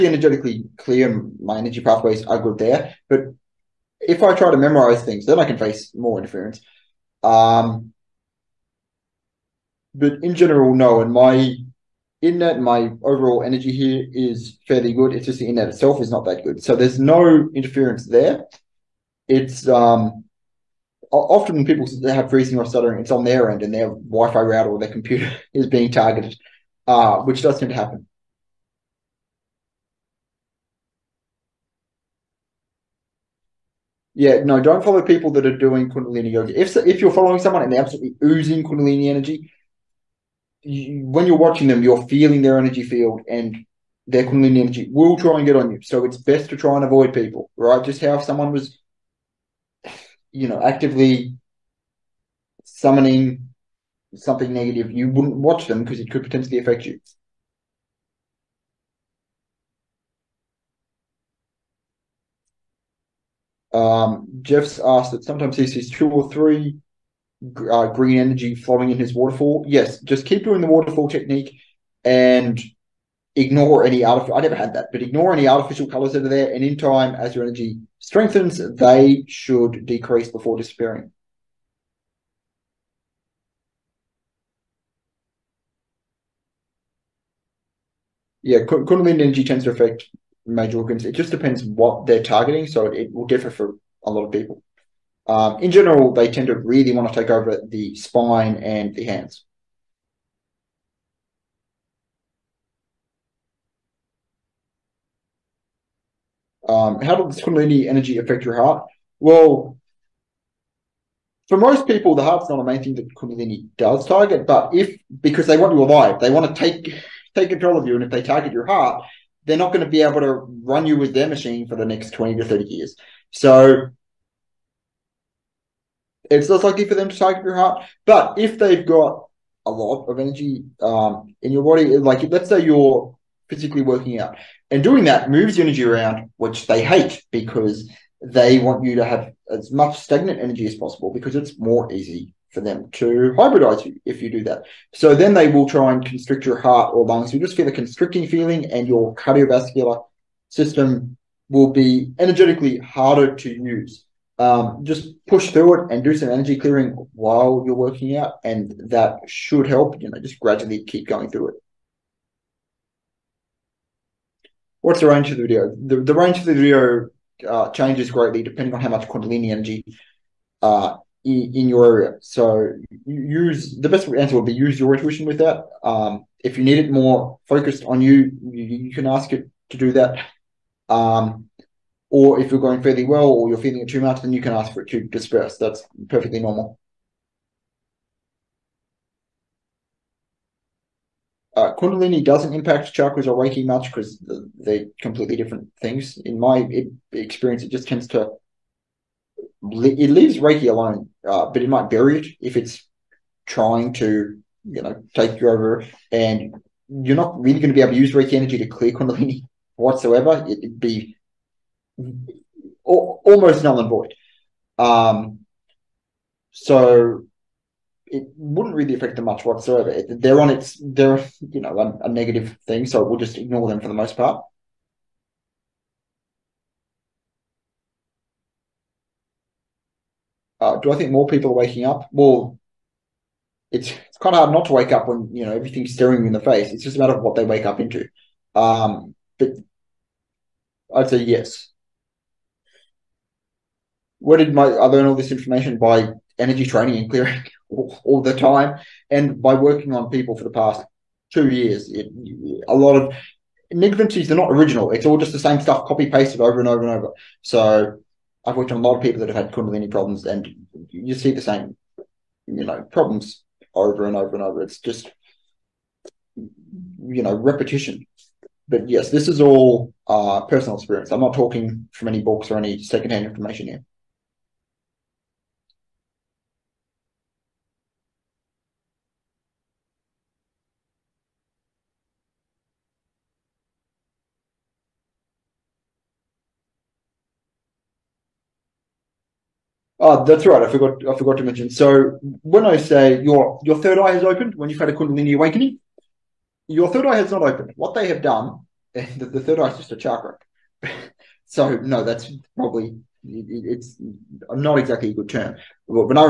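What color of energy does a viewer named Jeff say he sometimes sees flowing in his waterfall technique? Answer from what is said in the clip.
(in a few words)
Green.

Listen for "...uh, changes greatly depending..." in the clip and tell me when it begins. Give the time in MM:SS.
02:47.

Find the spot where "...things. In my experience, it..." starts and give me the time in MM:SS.
03:15.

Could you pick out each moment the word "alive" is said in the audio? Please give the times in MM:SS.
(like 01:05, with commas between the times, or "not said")
01:55.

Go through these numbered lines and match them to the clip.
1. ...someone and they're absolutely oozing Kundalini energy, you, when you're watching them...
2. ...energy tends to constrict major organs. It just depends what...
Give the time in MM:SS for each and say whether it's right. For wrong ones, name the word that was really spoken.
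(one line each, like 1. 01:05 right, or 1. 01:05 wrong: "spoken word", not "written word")
1. 00:37 right
2. 01:29 wrong: "affect", not "constrict".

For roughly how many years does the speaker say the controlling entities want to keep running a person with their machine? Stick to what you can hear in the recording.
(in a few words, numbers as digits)
20 to 30 years.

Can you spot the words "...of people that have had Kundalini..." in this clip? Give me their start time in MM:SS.
04:18.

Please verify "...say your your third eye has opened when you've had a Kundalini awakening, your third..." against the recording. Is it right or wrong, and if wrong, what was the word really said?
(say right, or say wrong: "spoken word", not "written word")
right.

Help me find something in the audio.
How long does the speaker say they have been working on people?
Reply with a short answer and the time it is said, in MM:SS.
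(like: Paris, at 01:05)
2 years, at 04:11.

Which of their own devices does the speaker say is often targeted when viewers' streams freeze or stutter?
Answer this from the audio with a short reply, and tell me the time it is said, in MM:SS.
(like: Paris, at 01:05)
Wi-Fi router, at 00:23.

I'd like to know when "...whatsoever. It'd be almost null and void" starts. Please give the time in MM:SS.
03:29.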